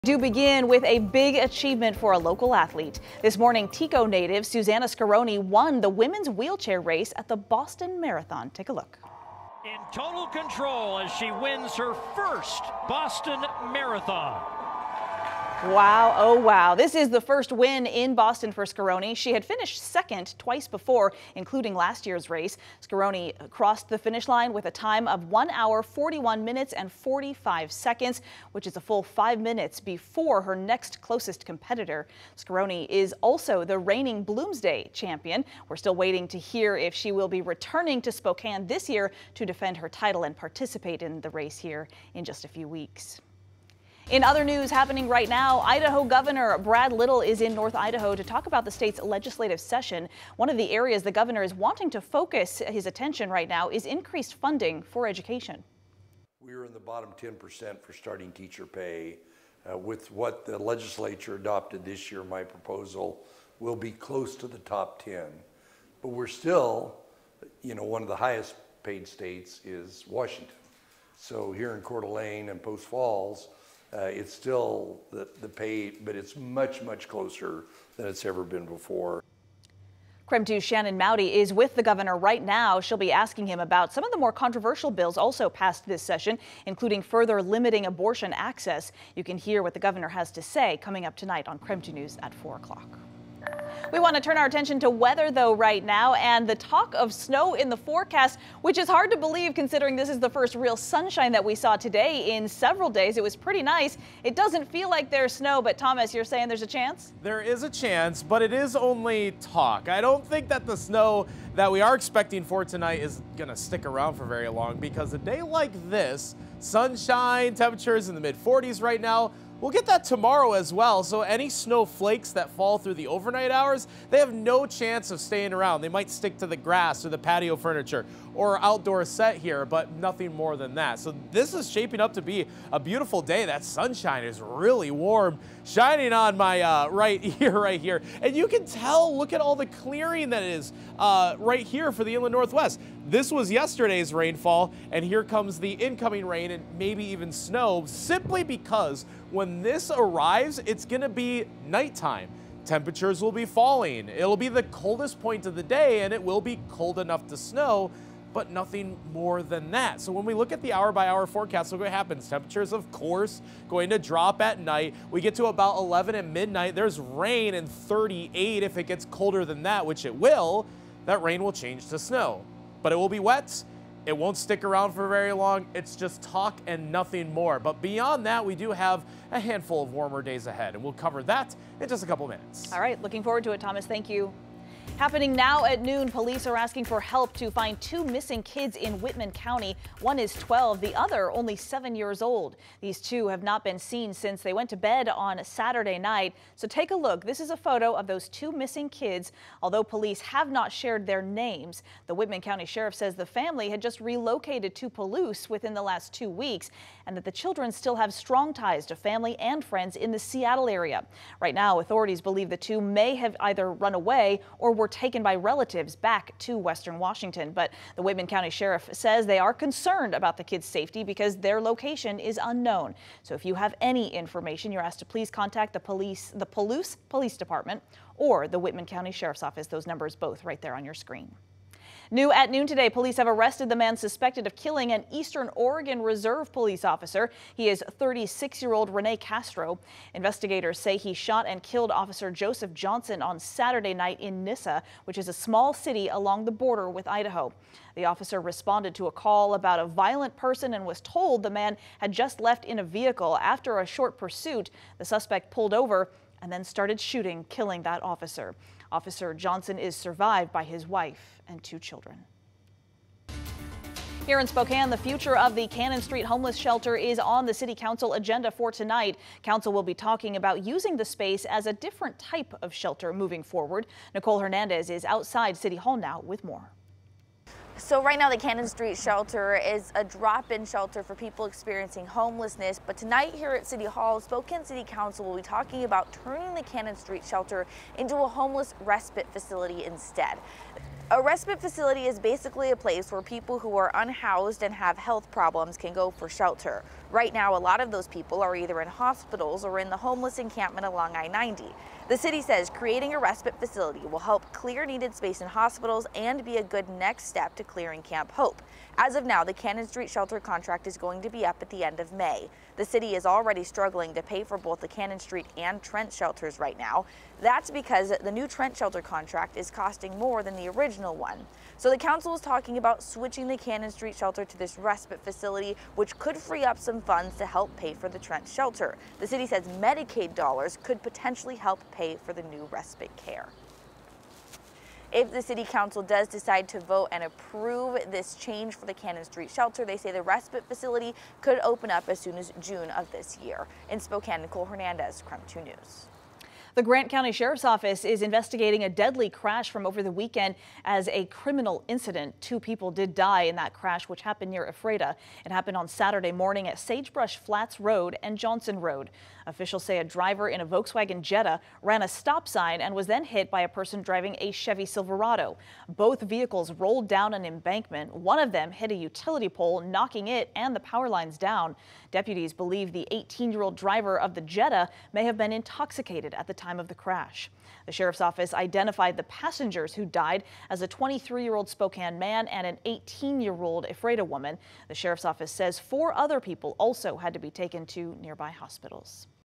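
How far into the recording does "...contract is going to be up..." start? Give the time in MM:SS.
05:10.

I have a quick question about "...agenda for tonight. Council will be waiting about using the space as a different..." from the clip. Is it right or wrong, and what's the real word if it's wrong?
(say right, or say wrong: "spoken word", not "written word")
wrong: "talking", not "waiting".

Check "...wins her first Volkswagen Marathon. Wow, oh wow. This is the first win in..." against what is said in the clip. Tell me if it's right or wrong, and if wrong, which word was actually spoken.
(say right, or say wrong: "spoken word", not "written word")
wrong: "Boston", not "Volkswagen".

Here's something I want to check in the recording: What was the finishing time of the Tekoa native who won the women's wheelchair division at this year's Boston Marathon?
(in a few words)
1 hour 41 minutes and 45 seconds.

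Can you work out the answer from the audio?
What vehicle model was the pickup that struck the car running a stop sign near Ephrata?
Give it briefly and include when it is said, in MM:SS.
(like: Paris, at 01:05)
Chevy Silverado, at 06:04.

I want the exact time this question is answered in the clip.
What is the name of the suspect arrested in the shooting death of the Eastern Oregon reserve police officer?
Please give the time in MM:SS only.
03:58.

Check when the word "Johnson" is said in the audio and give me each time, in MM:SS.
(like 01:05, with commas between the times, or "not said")
04:02, 04:19, 05:58.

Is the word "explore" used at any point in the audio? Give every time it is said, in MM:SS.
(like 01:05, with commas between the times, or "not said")
not said.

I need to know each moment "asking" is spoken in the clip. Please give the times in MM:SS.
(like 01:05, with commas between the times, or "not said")
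01:23, 03:06.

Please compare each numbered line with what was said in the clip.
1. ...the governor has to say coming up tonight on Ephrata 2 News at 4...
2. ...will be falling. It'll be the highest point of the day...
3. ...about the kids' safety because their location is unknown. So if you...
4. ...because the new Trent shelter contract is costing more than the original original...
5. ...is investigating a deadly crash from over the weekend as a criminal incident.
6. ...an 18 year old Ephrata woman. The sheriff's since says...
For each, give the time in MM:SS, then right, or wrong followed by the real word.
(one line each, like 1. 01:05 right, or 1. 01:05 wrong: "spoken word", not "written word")
1. 01:29 wrong: "KREM", not "Ephrata"
2. 02:33 wrong: "coldest", not "highest"
3. 03:40 right
4. 05:17 right
5. 05:48 right
6. 06:22 wrong: "office", not "since".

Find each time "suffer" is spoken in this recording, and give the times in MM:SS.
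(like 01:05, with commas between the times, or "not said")
not said.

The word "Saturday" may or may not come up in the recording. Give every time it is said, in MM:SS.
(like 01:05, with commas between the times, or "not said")
03:15, 04:03, 05:55.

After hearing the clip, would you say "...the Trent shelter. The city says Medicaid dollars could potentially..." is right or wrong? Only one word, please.
right.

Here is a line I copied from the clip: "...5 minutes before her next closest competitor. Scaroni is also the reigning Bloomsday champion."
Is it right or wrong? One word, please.
right.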